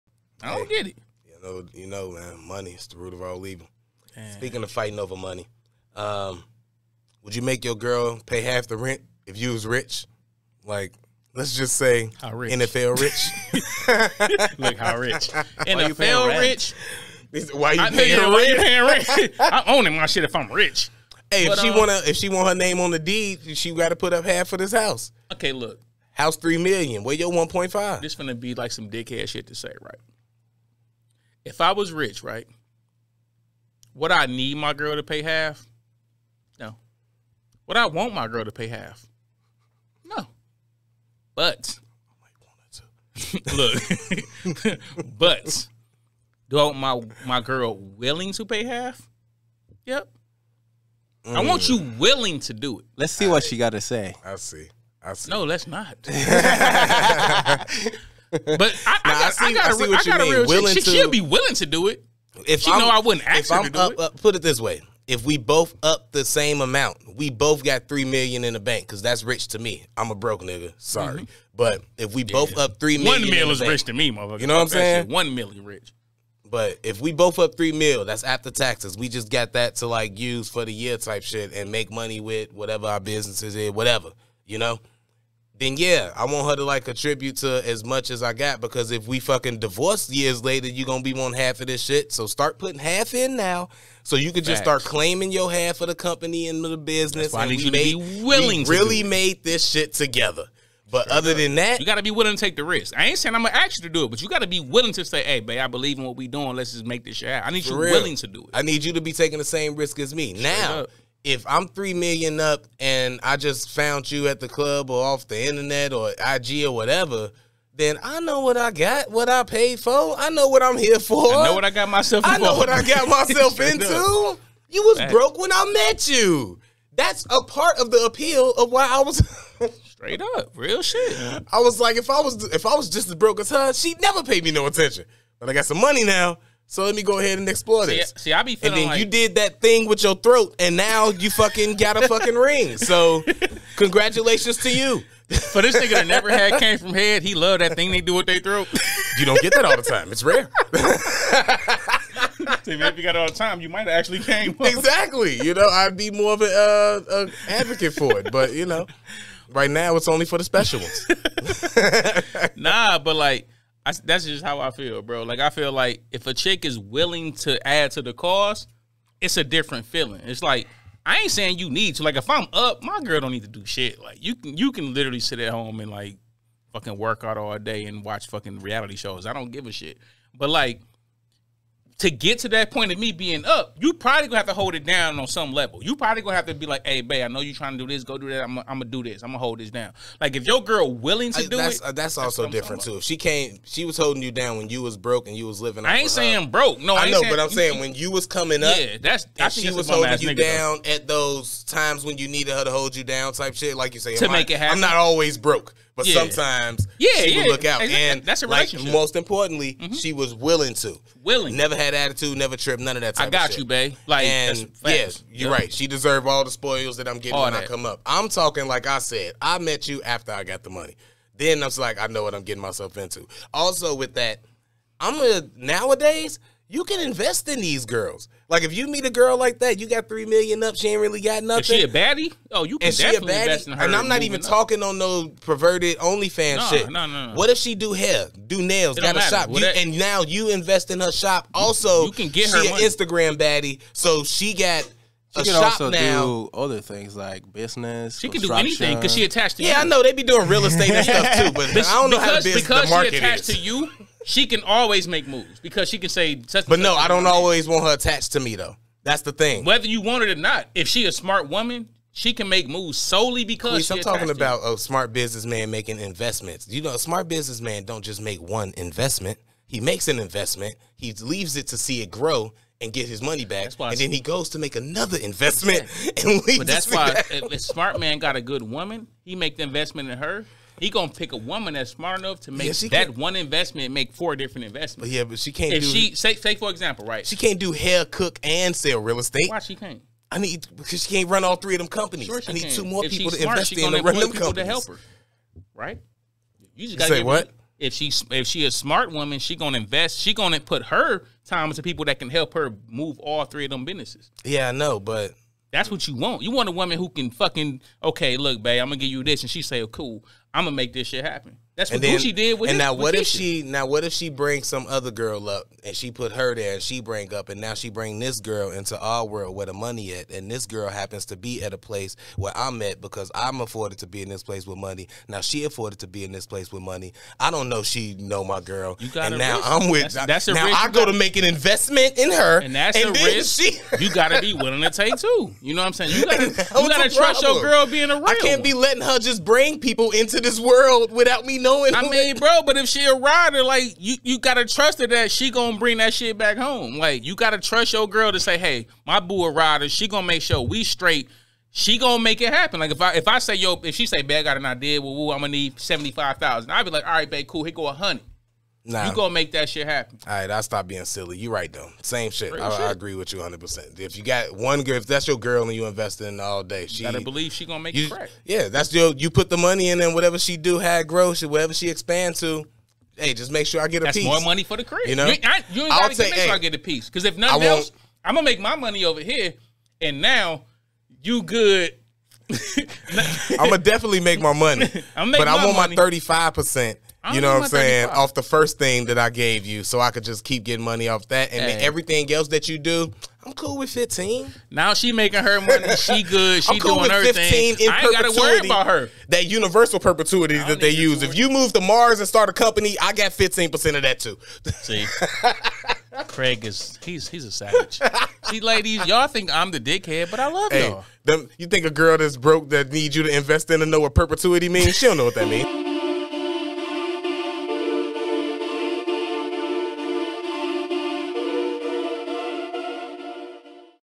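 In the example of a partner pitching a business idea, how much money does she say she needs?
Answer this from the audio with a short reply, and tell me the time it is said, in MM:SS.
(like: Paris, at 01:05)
$75,000, at 05:55.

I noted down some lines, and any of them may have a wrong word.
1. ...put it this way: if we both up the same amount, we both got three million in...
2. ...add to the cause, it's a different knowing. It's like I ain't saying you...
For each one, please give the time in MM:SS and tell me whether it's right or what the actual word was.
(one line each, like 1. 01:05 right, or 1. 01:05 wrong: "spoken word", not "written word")
1. 01:04 right
2. 02:47 wrong: "feeling", not "knowing".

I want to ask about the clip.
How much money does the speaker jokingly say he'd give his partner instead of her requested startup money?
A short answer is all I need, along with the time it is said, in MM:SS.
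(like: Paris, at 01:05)
100 thousand, at 05:57.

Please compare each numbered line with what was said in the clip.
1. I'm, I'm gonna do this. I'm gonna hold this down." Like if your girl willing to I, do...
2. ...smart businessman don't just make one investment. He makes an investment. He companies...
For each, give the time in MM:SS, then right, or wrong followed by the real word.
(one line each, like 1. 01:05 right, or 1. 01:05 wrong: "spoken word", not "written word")
1. 03:08 right
2. 04:26 wrong: "leaves", not "companies".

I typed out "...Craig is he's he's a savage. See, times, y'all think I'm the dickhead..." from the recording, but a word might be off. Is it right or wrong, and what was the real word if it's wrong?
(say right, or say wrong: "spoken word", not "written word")
wrong: "ladies", not "times".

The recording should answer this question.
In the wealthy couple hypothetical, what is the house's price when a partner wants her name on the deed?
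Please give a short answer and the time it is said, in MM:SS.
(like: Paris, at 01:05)
3 million, at 00:26.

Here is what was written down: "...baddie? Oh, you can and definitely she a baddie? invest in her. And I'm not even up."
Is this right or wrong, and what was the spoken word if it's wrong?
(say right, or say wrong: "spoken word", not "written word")
right.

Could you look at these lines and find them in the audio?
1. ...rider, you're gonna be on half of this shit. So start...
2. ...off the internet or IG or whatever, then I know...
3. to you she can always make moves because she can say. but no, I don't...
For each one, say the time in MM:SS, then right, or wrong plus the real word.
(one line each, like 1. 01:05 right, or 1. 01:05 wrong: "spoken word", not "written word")
1. 01:30 wrong: "later", not "rider"
2. 01:55 right
3. 04:13 right.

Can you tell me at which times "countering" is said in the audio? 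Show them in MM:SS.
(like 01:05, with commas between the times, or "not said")
not said.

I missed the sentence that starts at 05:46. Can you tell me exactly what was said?
Like you gotta trust your girl to say, "Hey, my boo a rider.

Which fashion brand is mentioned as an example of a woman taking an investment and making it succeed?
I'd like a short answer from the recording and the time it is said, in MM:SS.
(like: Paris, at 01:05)
Gucci, at 05:12.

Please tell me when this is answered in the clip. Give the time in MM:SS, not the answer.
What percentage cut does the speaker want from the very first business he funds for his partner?
06:25.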